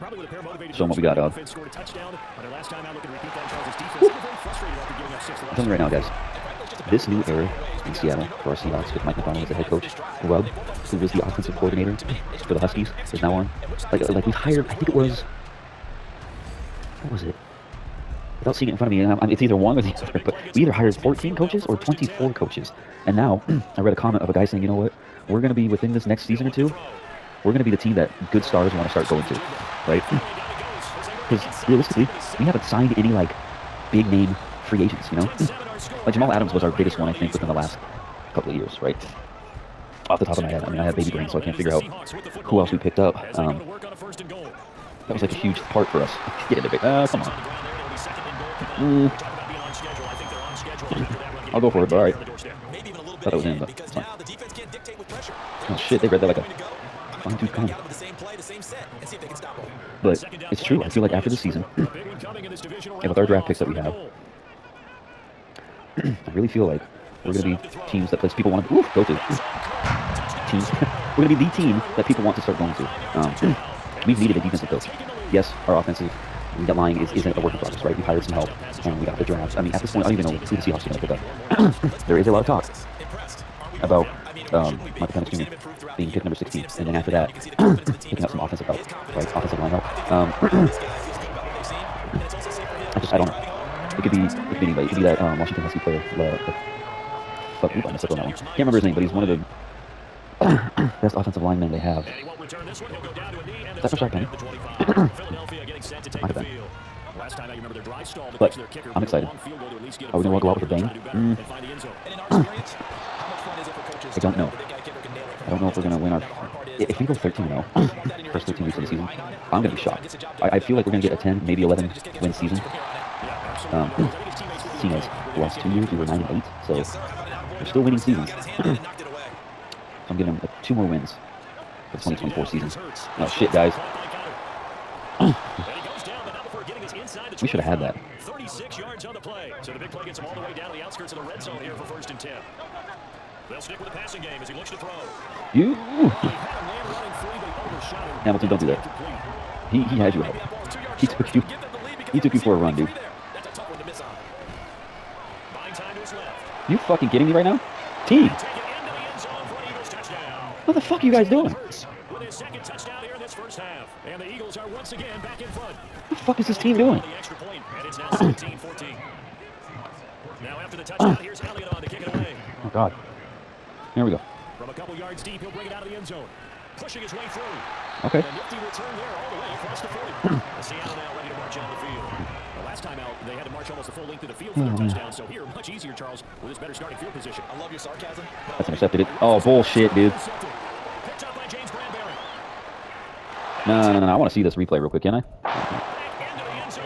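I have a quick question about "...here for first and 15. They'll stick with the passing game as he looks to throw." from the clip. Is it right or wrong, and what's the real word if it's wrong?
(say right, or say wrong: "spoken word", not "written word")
wrong: "10", not "15".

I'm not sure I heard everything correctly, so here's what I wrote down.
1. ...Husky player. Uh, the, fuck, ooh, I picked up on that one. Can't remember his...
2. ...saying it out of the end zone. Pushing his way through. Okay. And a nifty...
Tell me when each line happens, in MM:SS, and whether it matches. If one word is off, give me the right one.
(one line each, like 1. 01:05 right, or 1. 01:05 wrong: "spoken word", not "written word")
1. 01:35 wrong: "messed", not "picked"
2. 02:55 wrong: "bring", not "saying".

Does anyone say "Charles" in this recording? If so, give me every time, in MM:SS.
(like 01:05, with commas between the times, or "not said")
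00:03, 03:05.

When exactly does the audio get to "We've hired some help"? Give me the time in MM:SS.
01:17.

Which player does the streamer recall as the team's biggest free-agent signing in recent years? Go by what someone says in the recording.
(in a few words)
Jamal Adams.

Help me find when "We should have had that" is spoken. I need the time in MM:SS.
02:17.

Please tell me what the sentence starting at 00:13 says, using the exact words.
Like, like we've hired, I think it was what was it?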